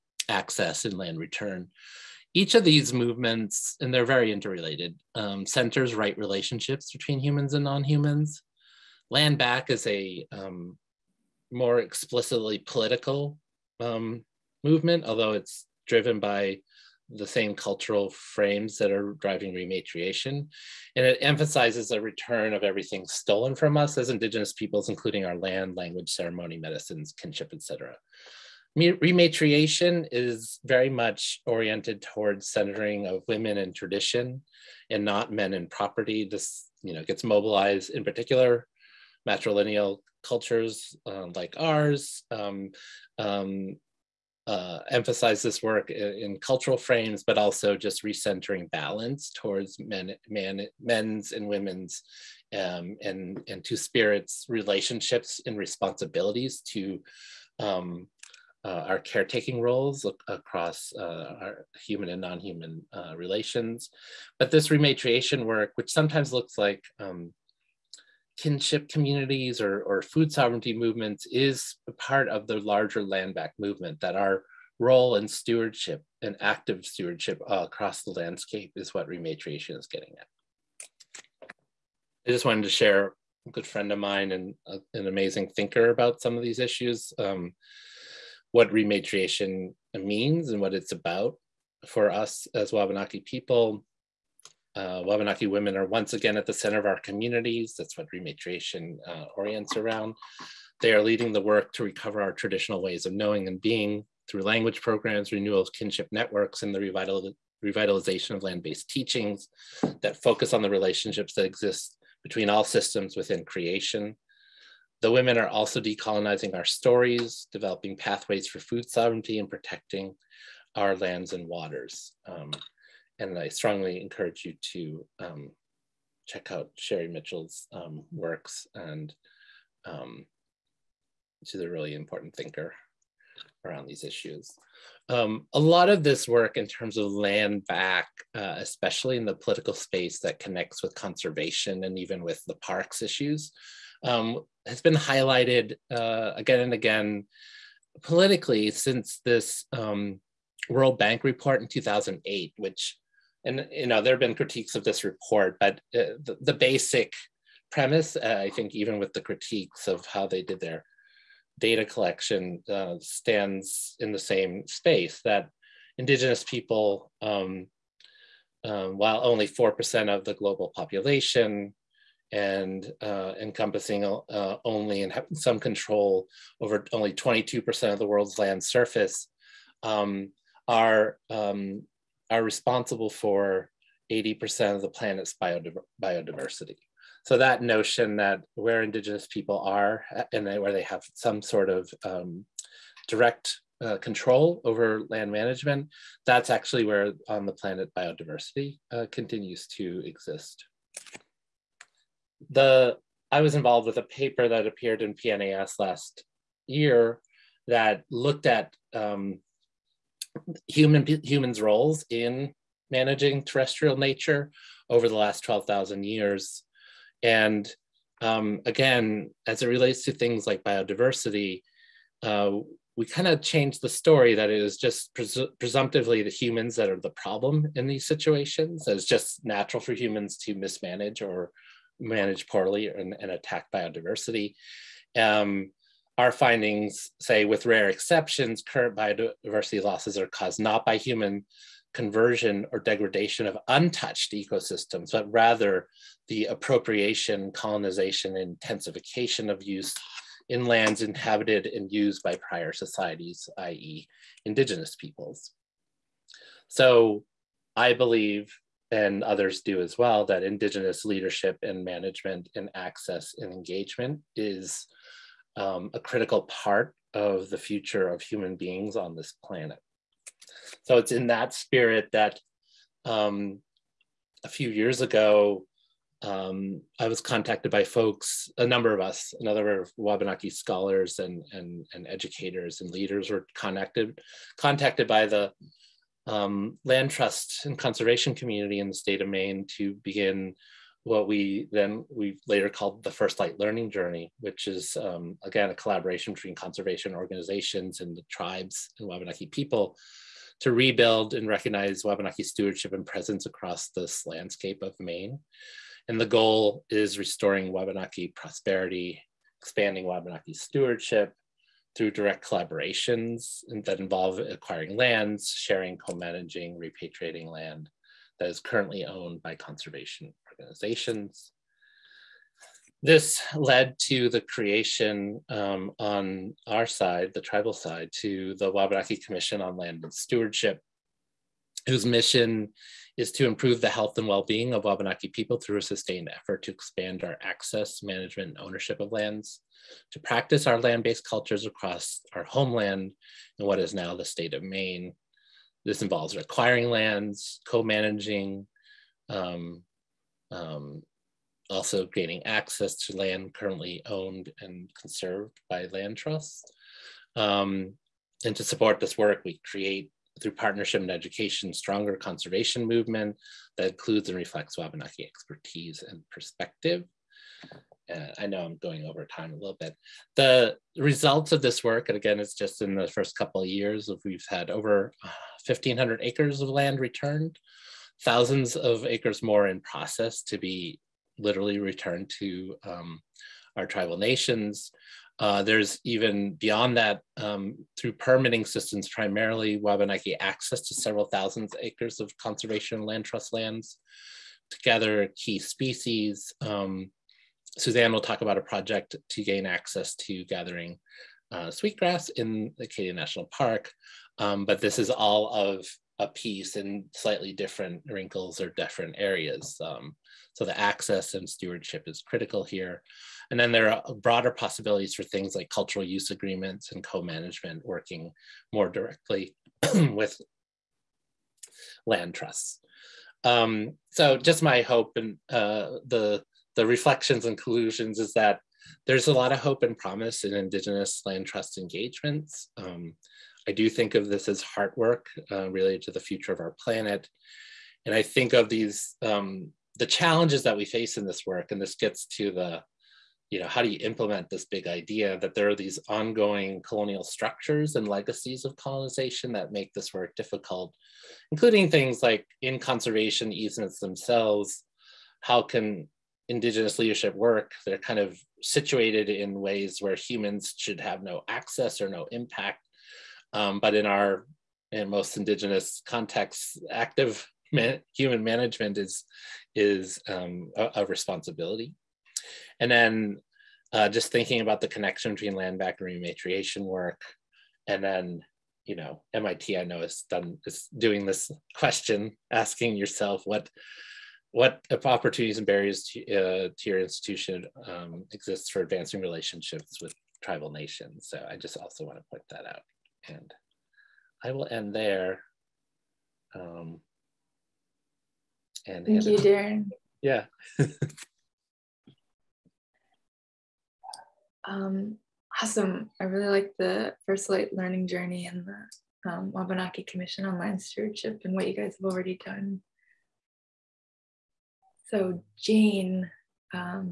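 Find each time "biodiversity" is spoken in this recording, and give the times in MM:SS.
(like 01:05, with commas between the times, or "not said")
03:05, 03:17, 03:40, 03:53, 03:58.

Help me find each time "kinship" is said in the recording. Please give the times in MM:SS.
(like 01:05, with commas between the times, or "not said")
00:27, 01:08, 01:45.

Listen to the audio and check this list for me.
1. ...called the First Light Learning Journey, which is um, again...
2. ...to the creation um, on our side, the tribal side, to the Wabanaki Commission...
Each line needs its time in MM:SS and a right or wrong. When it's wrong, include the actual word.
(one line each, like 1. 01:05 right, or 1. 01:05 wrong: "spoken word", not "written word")
1. 04:52 right
2. 05:24 right.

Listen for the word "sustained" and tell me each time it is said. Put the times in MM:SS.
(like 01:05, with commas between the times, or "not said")
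05:35.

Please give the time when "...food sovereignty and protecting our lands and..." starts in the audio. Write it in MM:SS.
01:58.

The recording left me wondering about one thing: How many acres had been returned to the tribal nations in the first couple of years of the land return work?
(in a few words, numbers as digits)
1,500 acres.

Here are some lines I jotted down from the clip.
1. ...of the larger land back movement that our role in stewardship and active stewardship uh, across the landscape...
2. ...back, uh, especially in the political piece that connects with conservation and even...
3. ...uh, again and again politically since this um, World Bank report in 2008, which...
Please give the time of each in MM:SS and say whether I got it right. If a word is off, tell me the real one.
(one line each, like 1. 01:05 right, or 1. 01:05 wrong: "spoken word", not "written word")
1. 01:12 right
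2. 02:17 wrong: "space", not "piece"
3. 02:25 right.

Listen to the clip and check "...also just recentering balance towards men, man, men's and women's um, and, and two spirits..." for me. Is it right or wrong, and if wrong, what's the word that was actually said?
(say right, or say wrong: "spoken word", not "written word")
right.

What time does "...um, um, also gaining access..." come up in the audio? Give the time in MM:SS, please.
05:49.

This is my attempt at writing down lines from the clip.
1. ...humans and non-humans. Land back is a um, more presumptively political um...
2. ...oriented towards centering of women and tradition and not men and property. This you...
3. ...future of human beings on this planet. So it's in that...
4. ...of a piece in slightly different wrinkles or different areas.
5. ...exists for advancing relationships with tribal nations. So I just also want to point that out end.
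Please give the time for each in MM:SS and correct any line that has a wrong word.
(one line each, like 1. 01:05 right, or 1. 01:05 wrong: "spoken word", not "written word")
1. 00:07 wrong: "explicitly", not "presumptively"
2. 00:31 right
3. 04:27 right
4. 06:45 right
5. 08:08 right.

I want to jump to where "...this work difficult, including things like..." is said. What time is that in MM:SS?
07:29.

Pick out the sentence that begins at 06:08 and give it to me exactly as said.
Uh, I know I'm going over time a little bit.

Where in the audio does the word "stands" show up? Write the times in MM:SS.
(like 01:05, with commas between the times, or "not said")
02:42.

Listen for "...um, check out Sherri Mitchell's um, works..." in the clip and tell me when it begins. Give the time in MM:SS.
02:05.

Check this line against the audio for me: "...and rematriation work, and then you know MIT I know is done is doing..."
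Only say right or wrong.
right.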